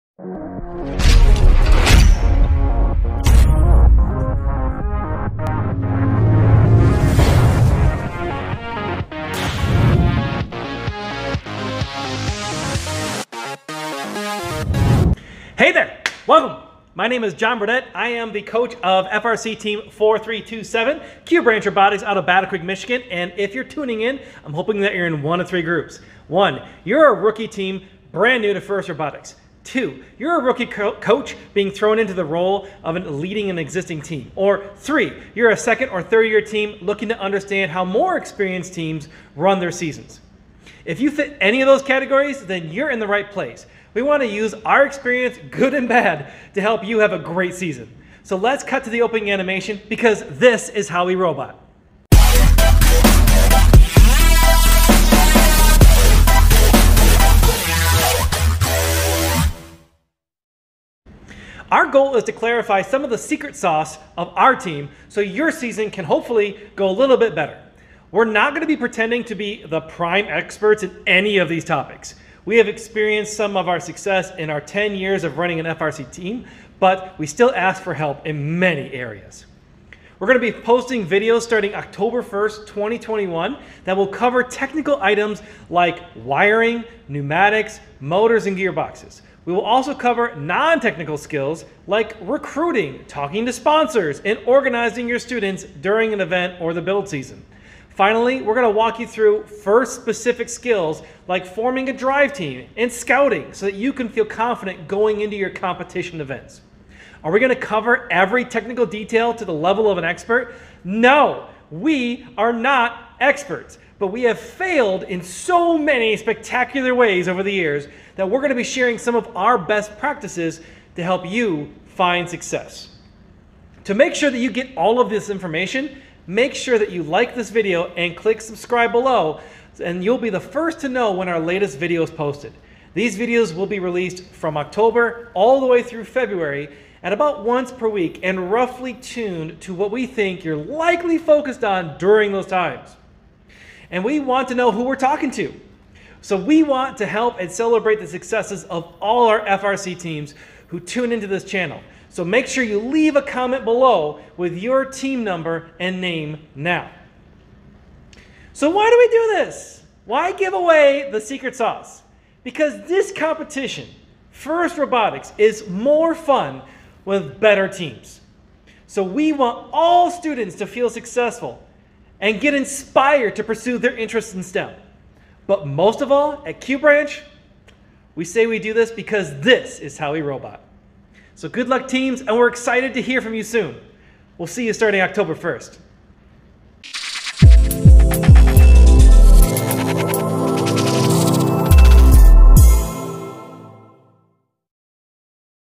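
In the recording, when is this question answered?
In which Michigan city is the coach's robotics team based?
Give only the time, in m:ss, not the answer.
0:22.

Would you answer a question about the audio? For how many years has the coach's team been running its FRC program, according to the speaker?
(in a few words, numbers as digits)
10.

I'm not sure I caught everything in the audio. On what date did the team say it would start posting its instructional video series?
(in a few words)
October 1st, 2021.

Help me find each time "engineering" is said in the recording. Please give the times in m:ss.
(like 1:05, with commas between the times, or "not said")
not said.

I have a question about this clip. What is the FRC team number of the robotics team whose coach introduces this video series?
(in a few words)
4327.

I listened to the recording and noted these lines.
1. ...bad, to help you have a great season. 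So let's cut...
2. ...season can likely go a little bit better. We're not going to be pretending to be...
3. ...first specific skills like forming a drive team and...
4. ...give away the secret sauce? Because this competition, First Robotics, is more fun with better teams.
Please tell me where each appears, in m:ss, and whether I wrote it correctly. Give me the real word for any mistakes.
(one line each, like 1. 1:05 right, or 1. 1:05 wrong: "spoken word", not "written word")
1. 0:45 right
2. 1:05 wrong: "hopefully", not "likely"
3. 1:39 right
4. 2:40 right.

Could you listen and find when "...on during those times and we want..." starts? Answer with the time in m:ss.
2:21.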